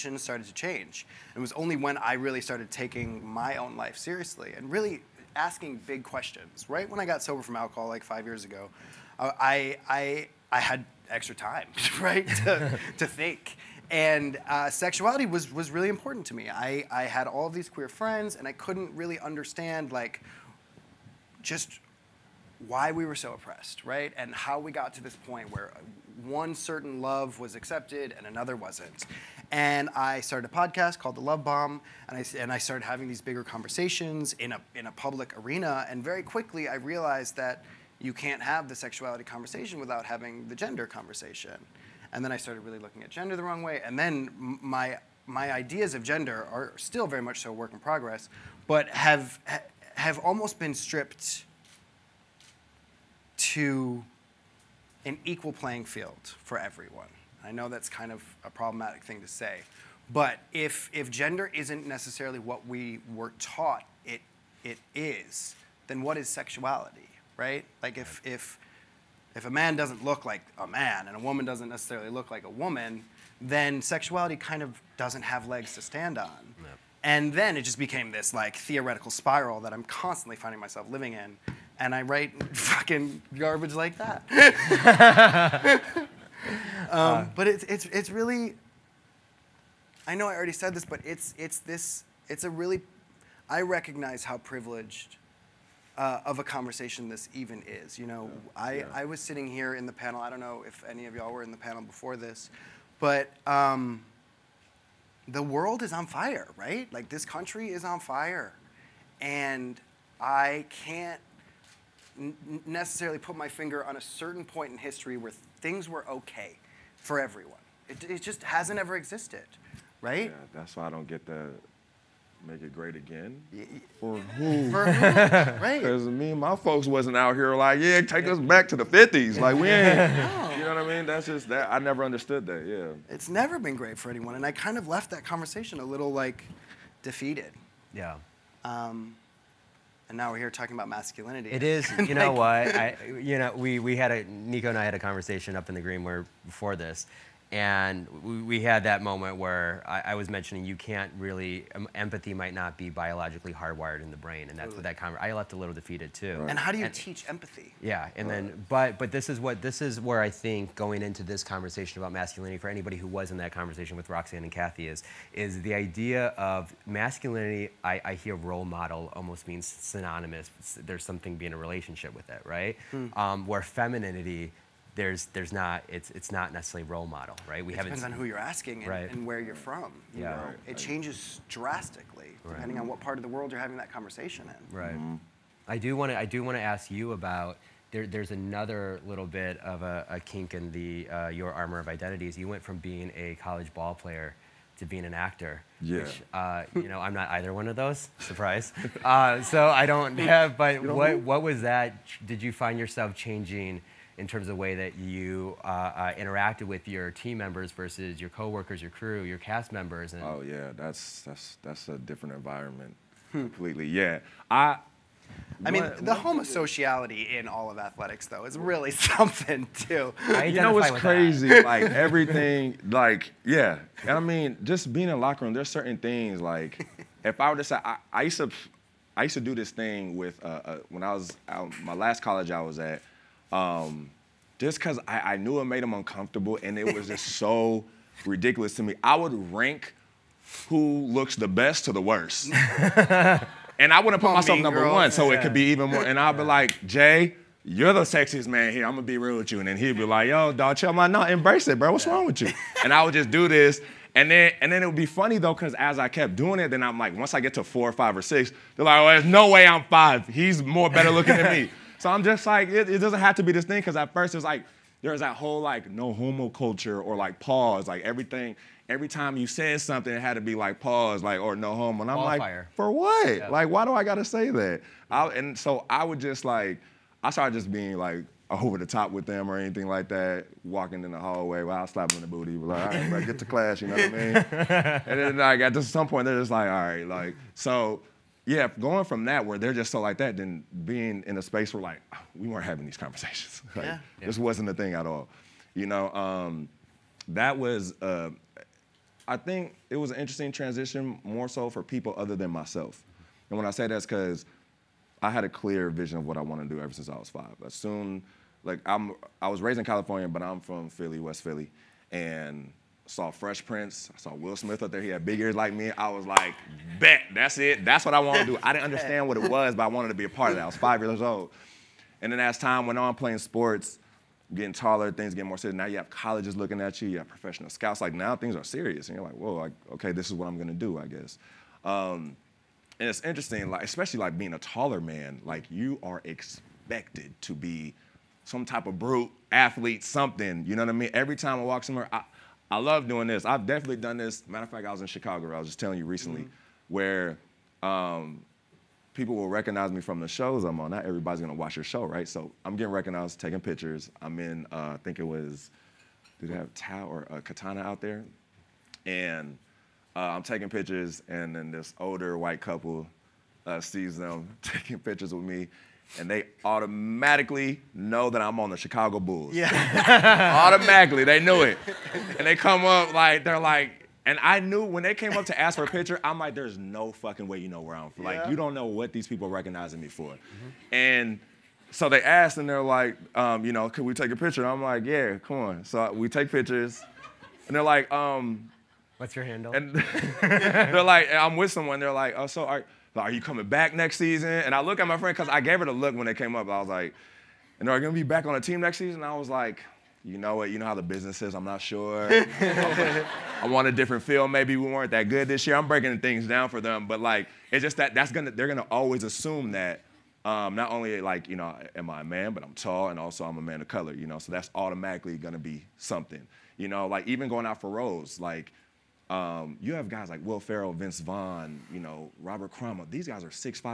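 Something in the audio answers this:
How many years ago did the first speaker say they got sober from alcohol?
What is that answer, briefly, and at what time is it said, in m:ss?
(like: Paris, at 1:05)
5, at 0:08.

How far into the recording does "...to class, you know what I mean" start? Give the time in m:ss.
4:43.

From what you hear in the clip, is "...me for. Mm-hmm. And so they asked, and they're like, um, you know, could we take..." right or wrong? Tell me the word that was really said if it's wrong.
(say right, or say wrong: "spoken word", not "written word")
right.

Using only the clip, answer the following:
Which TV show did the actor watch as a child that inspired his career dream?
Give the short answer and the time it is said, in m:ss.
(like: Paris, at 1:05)
Fresh Prince, at 5:13.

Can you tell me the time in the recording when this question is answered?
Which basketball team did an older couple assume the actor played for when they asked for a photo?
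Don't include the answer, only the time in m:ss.
6:08.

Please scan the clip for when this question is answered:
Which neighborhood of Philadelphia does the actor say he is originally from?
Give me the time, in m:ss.
5:11.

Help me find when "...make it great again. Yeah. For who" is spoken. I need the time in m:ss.
2:02.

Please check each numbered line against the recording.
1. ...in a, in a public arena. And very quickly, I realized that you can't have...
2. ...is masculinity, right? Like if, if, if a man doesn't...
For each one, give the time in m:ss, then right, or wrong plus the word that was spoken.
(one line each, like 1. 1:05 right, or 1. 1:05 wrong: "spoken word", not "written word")
1. 0:34 right
2. 1:06 wrong: "sexuality", not "masculinity".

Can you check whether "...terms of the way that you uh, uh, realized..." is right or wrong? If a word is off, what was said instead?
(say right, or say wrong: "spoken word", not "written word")
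wrong: "interacted", not "realized".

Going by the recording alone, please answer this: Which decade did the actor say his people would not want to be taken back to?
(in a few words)
the 50s.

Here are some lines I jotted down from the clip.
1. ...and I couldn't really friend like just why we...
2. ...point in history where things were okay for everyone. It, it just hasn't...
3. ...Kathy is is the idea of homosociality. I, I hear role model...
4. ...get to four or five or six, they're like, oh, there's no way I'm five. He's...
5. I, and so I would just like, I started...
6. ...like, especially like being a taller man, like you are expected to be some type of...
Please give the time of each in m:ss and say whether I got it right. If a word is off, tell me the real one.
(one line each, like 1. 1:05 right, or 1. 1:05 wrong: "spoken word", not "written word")
1. 0:18 wrong: "understand", not "friend"
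2. 1:54 right
3. 2:44 wrong: "masculinity", not "homosociality"
4. 4:17 right
5. 4:35 right
6. 5:33 right.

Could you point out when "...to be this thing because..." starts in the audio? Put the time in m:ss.
4:23.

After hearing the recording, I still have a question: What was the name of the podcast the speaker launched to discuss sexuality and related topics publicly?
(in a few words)
The Love Bomb.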